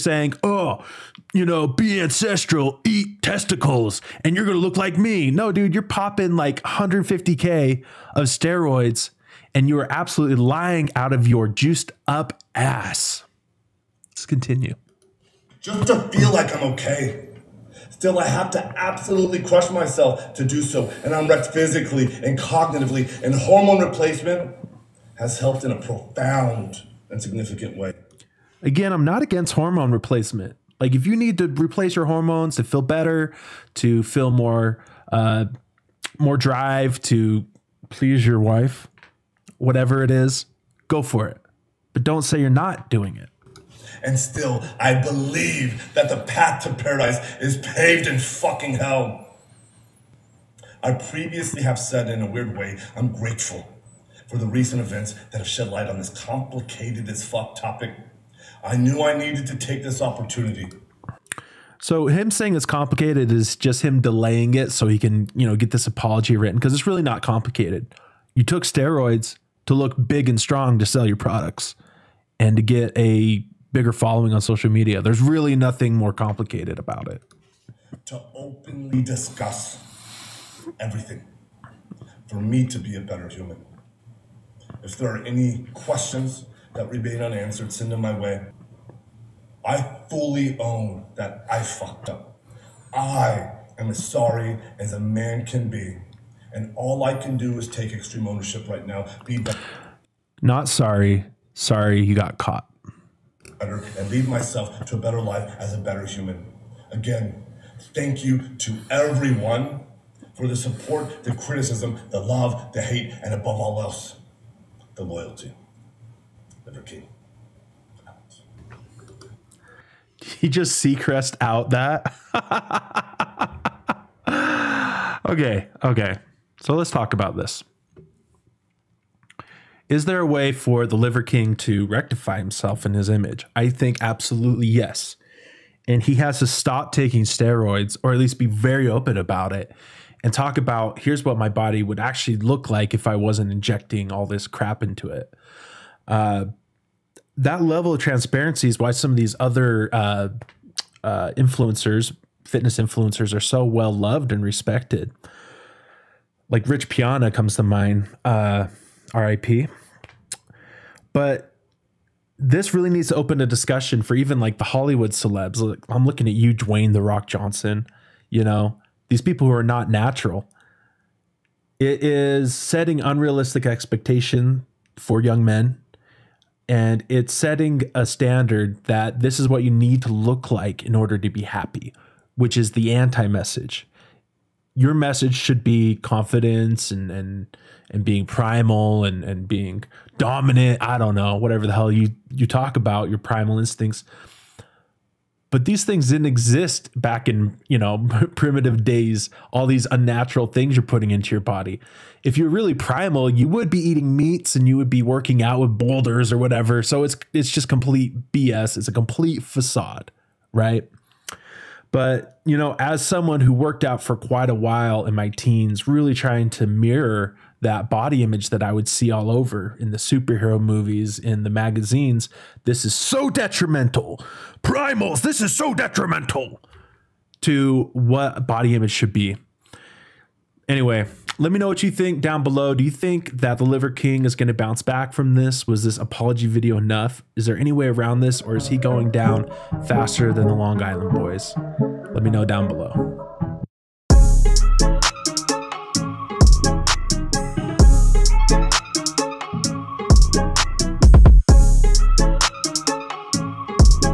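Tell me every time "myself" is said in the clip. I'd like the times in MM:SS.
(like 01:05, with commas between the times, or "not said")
00:19, 01:44.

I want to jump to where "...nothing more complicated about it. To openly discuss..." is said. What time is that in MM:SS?
01:15.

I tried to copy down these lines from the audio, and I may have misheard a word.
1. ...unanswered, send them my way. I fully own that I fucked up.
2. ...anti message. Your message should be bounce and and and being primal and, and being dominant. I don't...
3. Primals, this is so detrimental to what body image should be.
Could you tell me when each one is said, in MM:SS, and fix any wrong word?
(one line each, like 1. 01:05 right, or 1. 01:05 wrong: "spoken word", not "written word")
1. 01:27 right
2. 03:02 wrong: "confidence", not "bounce"
3. 03:44 right.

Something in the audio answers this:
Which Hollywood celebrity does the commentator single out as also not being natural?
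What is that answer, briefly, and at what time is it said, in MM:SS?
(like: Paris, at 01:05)
Dwayne the Rock Johnson, at 02:46.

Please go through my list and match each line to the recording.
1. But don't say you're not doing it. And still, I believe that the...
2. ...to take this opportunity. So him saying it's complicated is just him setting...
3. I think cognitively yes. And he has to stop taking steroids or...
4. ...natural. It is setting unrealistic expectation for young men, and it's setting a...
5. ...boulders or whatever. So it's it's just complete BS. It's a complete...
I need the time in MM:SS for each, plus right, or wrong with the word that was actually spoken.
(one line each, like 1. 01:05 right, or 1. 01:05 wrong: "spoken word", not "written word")
1. 00:41 right
2. 00:59 wrong: "delaying", not "setting"
3. 02:13 wrong: "absolutely", not "cognitively"
4. 02:49 right
5. 03:25 right.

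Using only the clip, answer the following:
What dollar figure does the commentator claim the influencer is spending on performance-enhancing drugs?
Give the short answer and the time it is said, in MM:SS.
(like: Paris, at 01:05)
150K, at 00:06.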